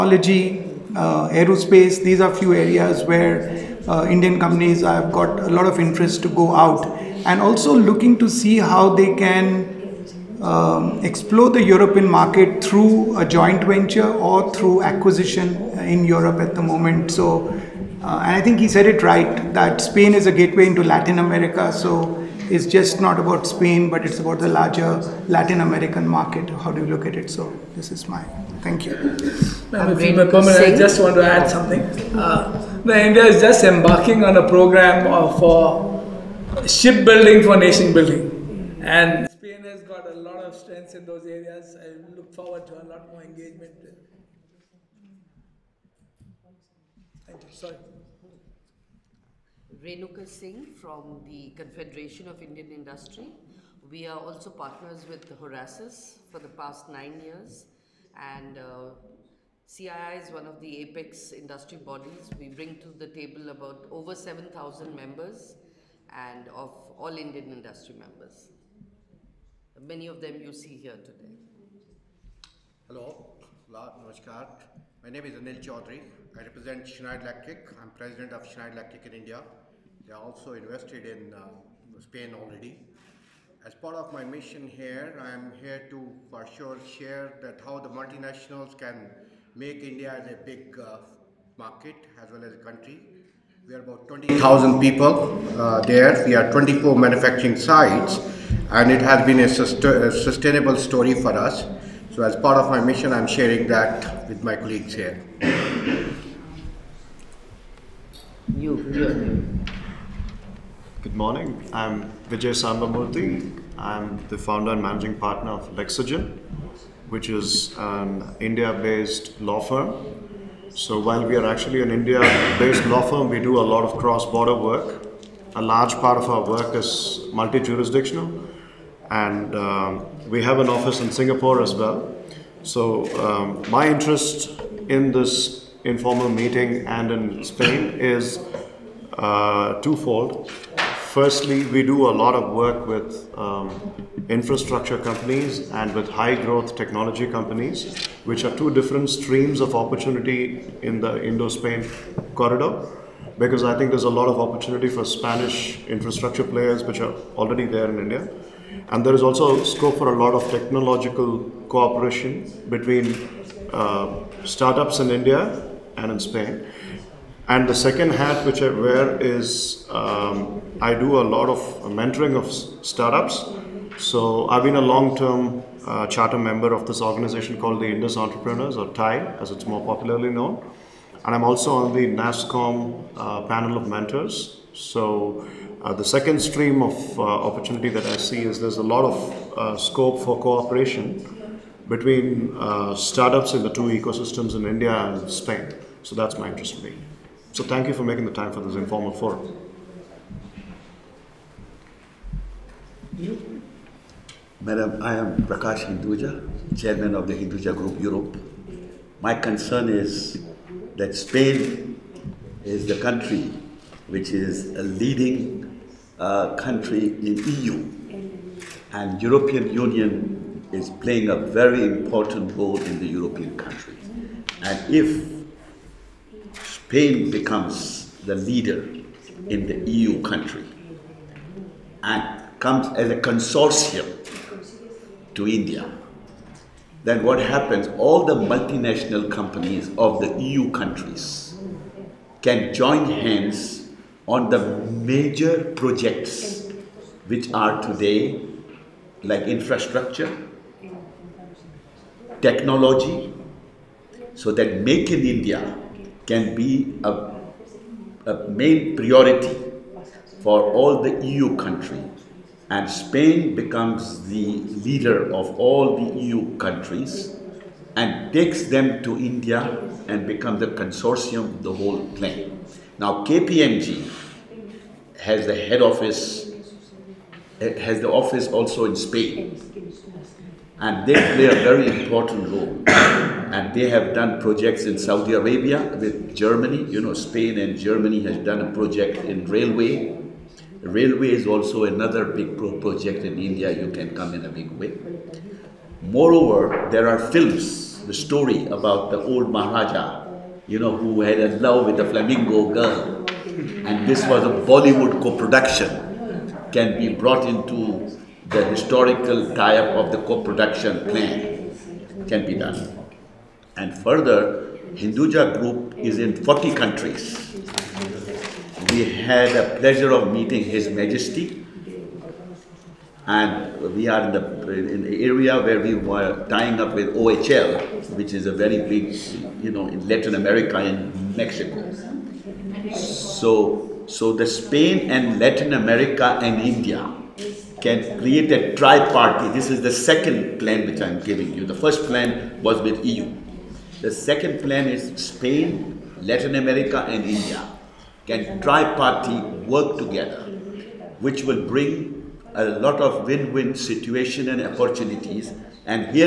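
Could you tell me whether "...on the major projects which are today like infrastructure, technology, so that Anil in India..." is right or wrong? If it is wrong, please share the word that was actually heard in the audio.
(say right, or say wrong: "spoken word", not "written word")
wrong: "Make", not "Anil".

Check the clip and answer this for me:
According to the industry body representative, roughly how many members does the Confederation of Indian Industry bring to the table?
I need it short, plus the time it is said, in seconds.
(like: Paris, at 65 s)
over 7,000, at 63 s.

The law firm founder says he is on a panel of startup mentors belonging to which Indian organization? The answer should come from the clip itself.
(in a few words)
NASSCOM.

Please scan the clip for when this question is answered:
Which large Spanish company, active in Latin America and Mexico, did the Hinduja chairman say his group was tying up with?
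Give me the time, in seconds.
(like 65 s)
327 s.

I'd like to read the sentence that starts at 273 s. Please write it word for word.
Now KPMG has the head office, eh, has the office also in Spain.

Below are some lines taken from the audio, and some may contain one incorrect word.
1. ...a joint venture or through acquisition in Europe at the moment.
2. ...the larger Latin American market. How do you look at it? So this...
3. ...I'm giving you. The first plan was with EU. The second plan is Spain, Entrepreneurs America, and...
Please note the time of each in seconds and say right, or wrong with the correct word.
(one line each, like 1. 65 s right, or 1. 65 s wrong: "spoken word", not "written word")
1. 13 s right
2. 24 s right
3. 341 s wrong: "Latin", not "Entrepreneurs".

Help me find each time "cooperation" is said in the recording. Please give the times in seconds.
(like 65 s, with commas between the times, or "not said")
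161 s, 190 s.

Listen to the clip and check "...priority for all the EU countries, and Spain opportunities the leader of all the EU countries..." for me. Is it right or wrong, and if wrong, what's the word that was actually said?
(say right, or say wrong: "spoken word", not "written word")
wrong: "becomes", not "opportunities".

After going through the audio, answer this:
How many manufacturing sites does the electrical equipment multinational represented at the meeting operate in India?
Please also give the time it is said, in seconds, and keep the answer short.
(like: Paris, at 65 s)
24, at 96 s.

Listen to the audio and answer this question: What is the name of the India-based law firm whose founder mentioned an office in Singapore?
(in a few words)
Lexygen.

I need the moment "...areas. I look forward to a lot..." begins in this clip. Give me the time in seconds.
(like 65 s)
41 s.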